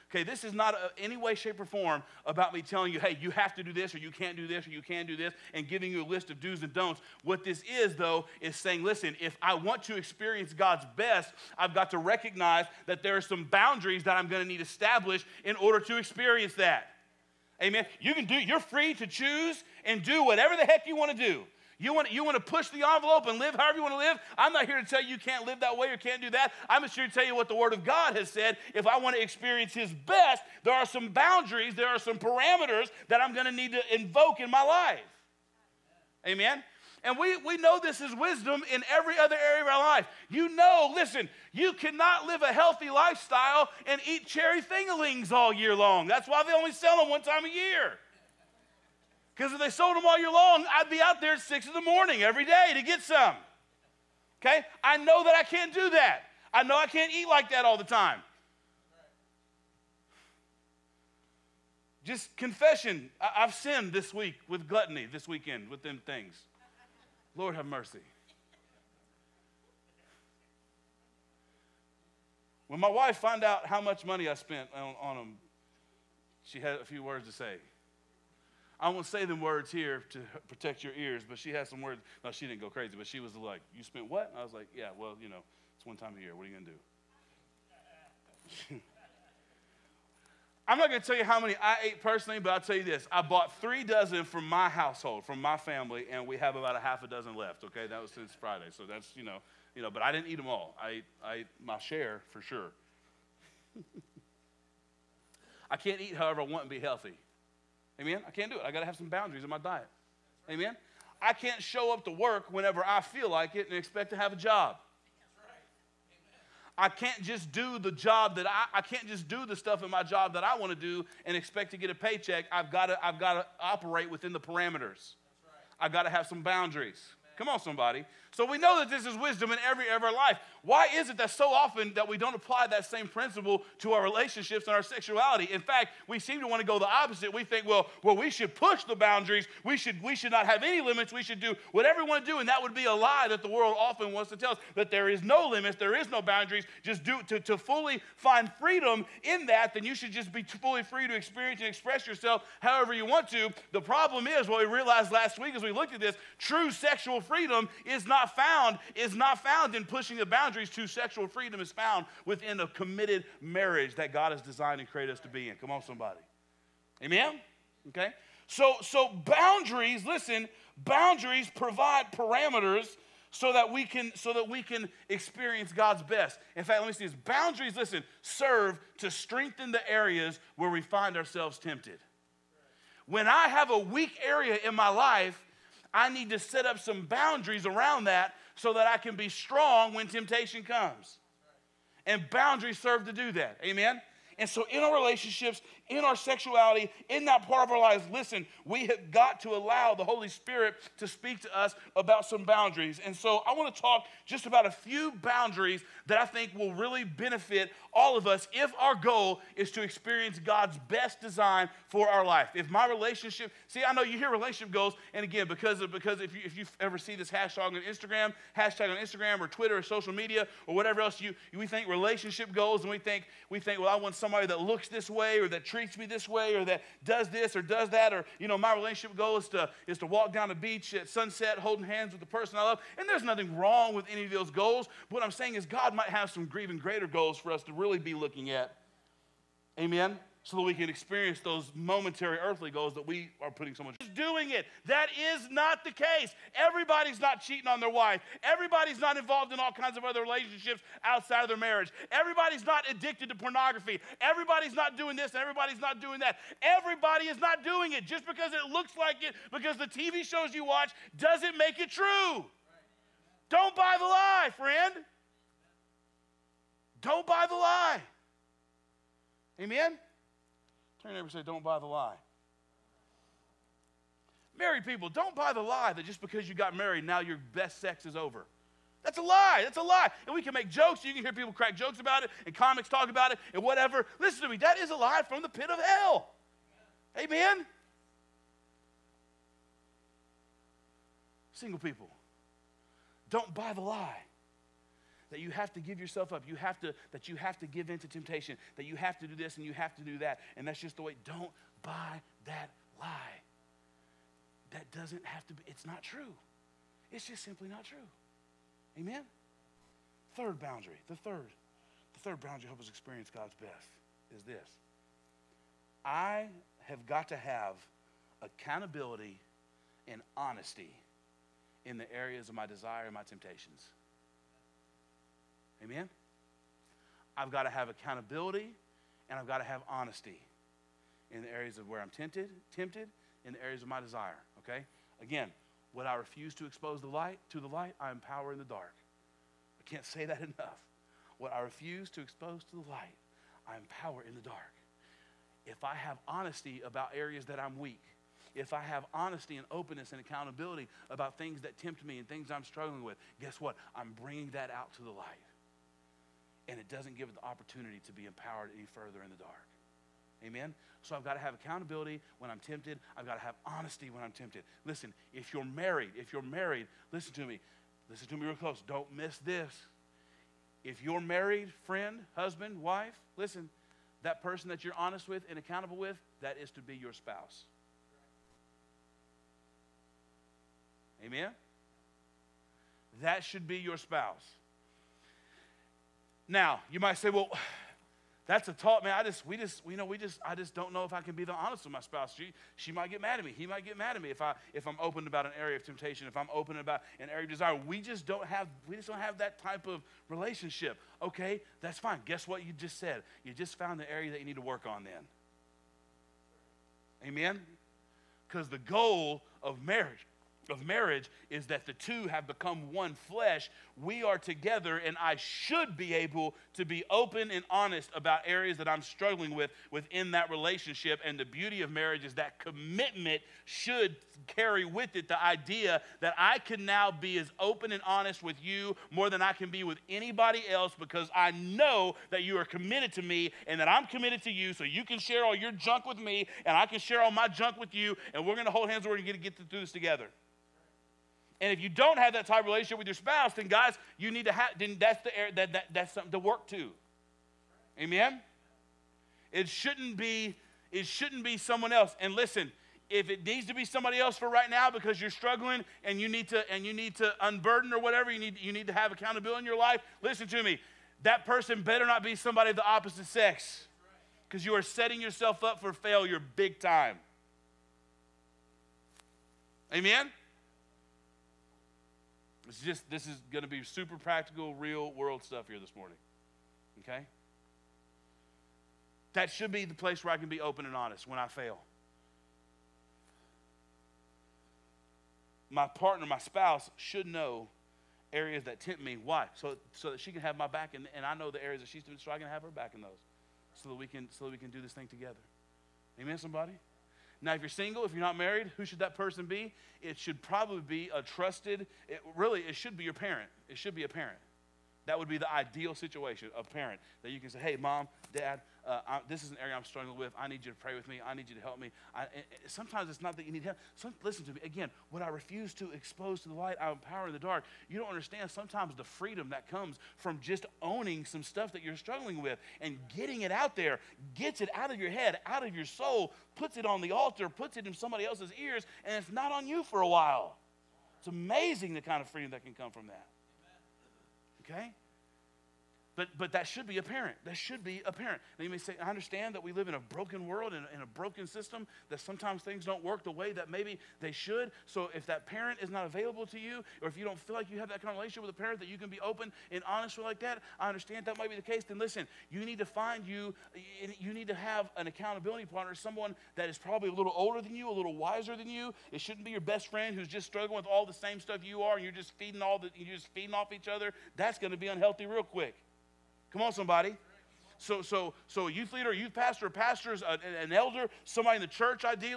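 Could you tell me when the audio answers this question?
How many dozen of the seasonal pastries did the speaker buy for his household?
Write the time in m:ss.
1:33.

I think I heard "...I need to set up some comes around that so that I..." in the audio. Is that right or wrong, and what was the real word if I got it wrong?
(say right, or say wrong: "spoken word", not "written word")
wrong: "boundaries", not "comes".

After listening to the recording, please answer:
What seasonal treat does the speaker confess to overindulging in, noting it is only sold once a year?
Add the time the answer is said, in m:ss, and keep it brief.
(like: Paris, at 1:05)
cherry fingerlings, at 0:44.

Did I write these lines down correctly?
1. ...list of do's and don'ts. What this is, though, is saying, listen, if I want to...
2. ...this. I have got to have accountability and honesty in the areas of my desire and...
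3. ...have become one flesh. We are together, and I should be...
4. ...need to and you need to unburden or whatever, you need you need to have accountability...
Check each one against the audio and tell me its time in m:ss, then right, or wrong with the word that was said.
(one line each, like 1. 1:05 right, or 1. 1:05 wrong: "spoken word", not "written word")
1. 0:06 right
2. 5:14 right
3. 6:52 right
4. 7:36 right.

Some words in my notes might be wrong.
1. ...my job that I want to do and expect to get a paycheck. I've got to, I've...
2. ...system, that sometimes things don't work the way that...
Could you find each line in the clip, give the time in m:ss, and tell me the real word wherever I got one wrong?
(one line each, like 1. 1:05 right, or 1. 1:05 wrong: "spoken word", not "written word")
1. 1:59 right
2. 9:01 right.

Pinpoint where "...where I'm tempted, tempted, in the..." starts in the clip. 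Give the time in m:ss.
5:31.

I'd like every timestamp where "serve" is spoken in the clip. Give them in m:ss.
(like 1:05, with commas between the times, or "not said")
2:58, 3:12.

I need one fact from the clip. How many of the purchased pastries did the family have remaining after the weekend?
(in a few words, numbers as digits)
half a dozen.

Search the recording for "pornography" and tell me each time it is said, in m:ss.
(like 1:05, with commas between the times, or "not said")
4:13.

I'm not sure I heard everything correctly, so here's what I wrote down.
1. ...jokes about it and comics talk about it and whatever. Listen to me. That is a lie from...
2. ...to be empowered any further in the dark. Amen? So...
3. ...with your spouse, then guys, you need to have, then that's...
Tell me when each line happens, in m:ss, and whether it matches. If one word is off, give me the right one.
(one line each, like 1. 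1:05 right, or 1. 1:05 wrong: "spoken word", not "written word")
1. 4:41 right
2. 5:58 right
3. 7:22 right.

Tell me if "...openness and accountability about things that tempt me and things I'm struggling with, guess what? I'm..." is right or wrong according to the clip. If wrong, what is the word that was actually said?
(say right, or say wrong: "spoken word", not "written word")
right.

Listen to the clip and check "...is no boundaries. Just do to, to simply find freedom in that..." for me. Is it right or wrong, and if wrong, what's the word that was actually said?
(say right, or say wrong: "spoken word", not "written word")
wrong: "fully", not "simply".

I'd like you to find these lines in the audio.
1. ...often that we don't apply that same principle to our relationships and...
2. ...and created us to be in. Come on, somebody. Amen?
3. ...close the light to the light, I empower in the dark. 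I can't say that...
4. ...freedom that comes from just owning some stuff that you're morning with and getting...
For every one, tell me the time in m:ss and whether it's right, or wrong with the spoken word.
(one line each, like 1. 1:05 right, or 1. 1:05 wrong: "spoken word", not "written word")
1. 2:11 right
2. 2:44 right
3. 5:36 wrong: "expose", not "close"
4. 8:39 wrong: "struggling", not "morning".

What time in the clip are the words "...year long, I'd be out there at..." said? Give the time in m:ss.
0:50.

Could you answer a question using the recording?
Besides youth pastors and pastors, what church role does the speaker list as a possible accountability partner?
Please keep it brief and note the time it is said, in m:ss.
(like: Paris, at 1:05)
an elder, at 9:30.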